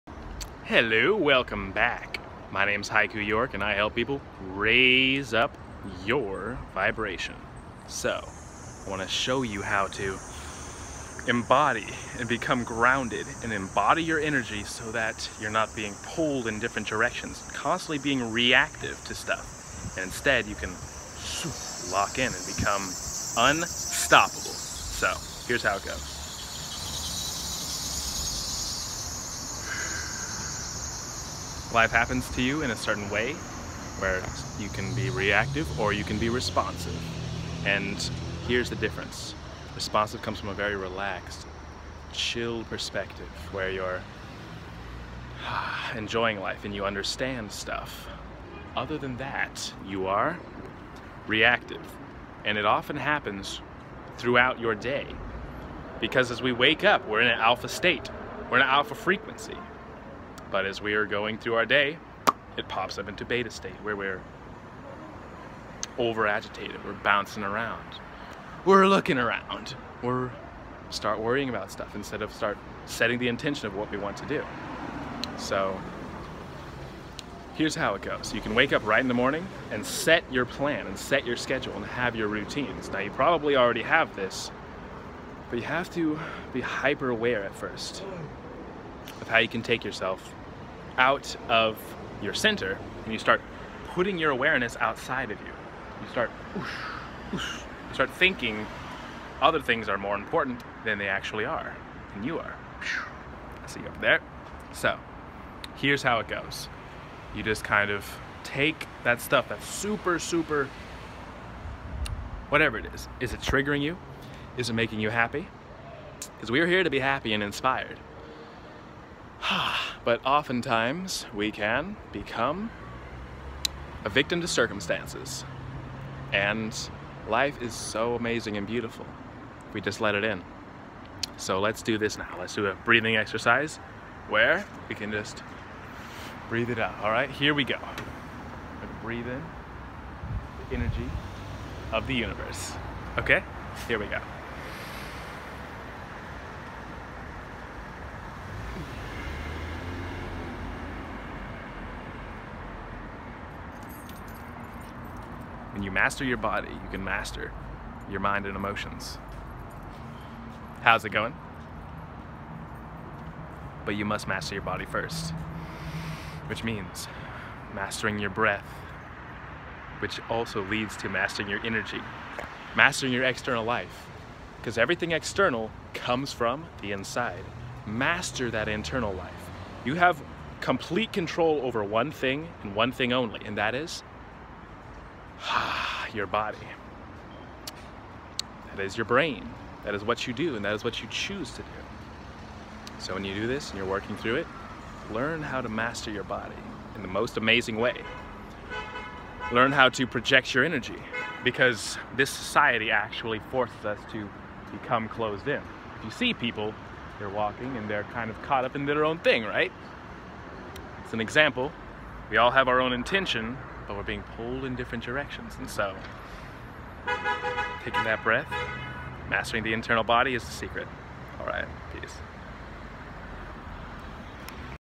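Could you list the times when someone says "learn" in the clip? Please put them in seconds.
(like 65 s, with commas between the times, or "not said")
195 s, 199 s.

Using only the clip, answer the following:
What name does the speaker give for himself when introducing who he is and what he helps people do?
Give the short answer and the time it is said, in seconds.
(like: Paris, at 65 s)
Haiku York, at 2 s.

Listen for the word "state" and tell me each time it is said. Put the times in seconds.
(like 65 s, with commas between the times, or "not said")
57 s, 63 s.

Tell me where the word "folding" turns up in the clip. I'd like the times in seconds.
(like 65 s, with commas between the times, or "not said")
not said.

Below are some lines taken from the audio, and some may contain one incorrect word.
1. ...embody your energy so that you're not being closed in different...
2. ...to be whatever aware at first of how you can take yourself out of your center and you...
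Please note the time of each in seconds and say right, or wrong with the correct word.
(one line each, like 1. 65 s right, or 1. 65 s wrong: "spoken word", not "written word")
1. 13 s wrong: "pulled", not "closed"
2. 85 s wrong: "hyper", not "whatever".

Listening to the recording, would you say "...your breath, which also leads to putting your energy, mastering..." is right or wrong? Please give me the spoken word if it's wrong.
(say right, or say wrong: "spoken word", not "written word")
wrong: "mastering", not "putting".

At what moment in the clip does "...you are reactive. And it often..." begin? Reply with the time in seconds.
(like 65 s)
49 s.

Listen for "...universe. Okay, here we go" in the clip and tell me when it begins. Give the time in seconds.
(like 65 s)
142 s.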